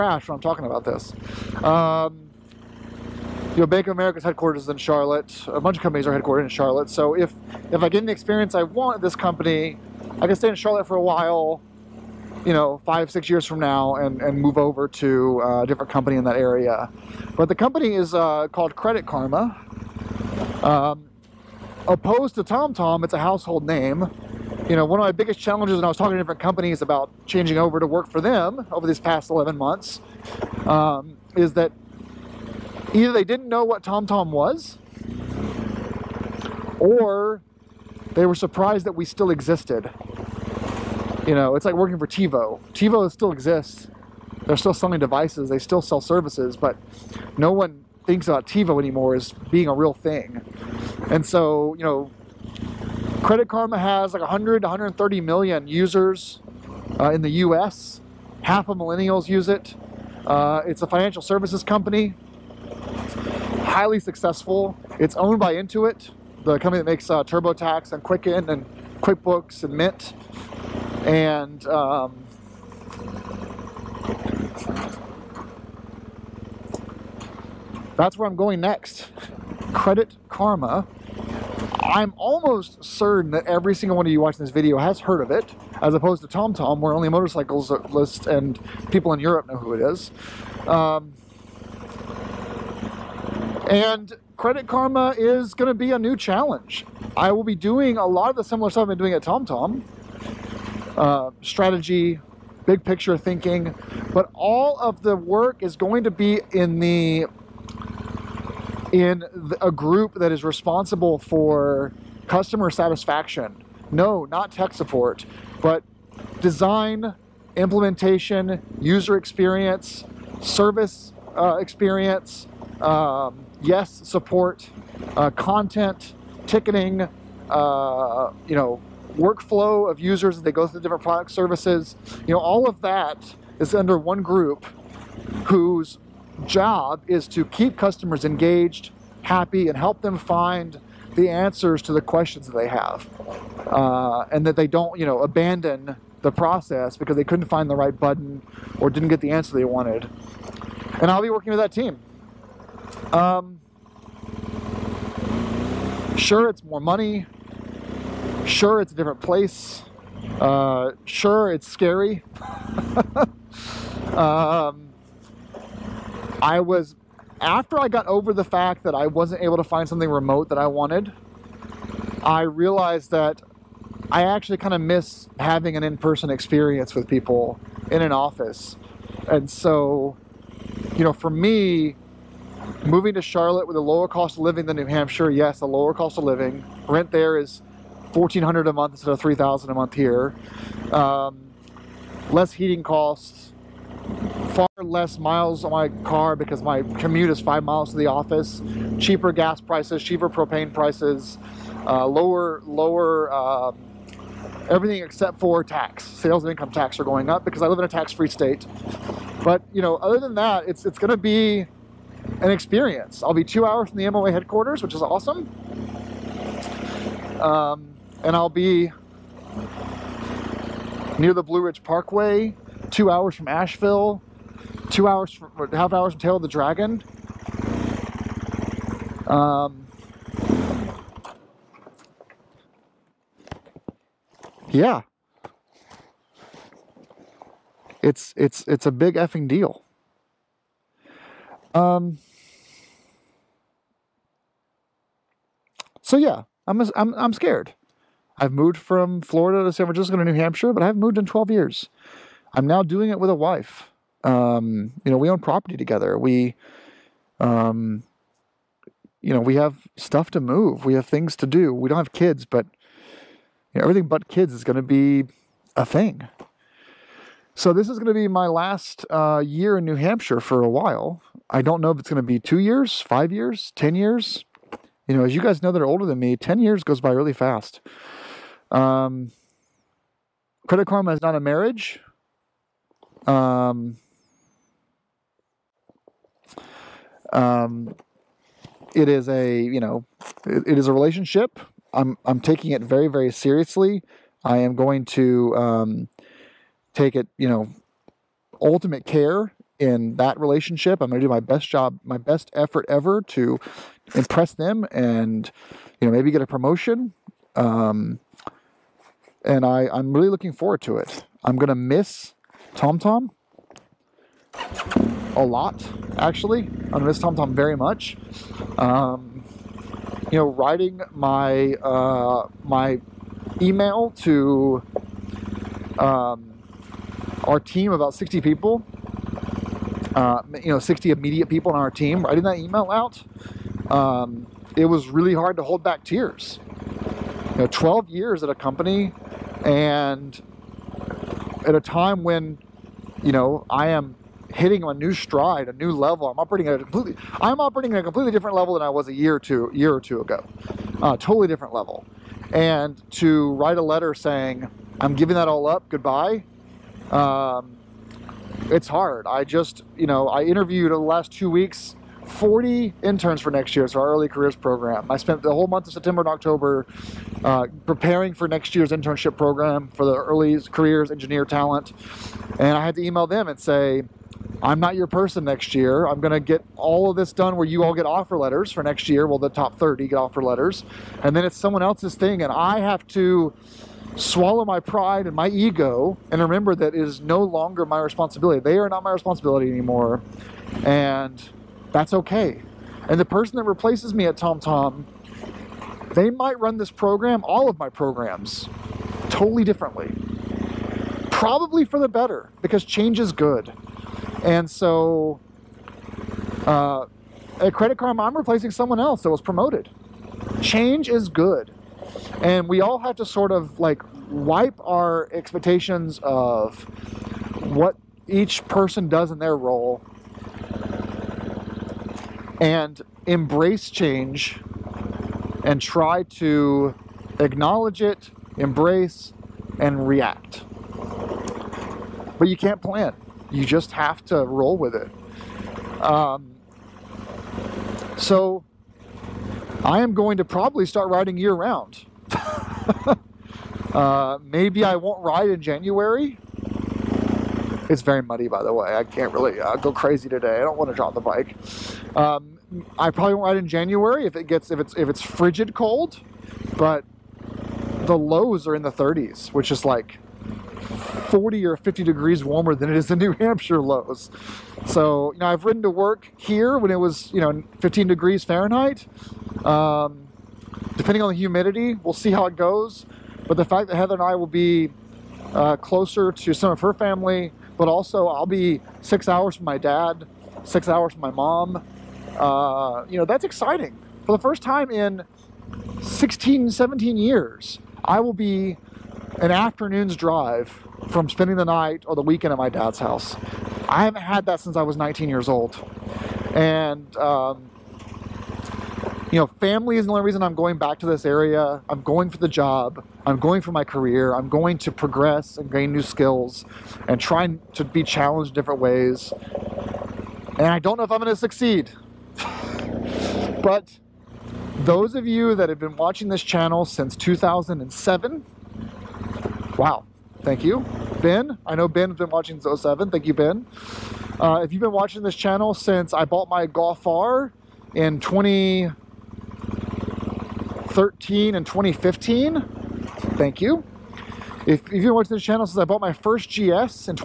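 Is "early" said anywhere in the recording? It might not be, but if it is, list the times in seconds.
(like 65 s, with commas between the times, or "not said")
364 s, 370 s.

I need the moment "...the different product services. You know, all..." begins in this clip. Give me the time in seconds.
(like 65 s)
130 s.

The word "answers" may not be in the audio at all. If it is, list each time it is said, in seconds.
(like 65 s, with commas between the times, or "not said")
141 s, 149 s.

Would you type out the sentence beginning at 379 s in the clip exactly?
Well, the top 30 get offer letters.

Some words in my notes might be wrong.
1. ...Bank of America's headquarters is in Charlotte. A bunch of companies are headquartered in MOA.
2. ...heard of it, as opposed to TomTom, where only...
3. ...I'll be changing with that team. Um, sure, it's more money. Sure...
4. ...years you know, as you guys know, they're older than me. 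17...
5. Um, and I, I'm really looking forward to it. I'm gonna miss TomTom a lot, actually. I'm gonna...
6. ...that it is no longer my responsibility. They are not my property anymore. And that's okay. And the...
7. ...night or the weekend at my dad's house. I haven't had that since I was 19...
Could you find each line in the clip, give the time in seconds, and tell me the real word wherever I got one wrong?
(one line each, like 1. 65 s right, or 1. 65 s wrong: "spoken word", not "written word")
1. 3 s wrong: "Charlotte", not "MOA"
2. 84 s right
3. 151 s wrong: "working", not "changing"
4. 273 s wrong: "10", not "17"
5. 307 s right
6. 386 s wrong: "responsibility", not "property"
7. 491 s right.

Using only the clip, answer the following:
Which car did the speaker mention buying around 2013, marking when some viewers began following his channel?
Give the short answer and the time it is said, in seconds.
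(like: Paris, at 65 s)
Golf R, at 526 s.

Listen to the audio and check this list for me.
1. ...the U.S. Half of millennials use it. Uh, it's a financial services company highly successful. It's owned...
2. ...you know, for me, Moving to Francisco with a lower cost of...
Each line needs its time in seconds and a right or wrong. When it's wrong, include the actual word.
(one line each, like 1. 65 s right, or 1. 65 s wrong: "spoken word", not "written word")
1. 57 s right
2. 180 s wrong: "Charlotte", not "Francisco".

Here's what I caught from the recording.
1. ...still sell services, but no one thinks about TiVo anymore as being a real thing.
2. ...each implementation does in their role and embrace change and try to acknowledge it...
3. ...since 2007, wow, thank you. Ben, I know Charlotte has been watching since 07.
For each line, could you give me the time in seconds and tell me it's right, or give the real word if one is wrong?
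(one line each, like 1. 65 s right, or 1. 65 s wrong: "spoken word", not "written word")
1. 45 s right
2. 418 s wrong: "person", not "implementation"
3. 516 s wrong: "Ben", not "Charlotte".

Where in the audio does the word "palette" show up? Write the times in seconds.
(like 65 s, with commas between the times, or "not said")
not said.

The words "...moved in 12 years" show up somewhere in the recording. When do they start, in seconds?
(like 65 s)
251 s.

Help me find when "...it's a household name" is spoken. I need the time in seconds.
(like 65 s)
23 s.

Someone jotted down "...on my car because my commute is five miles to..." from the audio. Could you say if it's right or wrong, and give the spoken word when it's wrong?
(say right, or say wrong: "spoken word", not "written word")
right.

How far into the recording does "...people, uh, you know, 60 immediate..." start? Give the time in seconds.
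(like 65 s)
328 s.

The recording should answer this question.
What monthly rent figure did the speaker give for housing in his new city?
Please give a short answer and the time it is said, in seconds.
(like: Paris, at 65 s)
1400, at 188 s.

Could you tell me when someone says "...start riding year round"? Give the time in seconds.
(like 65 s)
440 s.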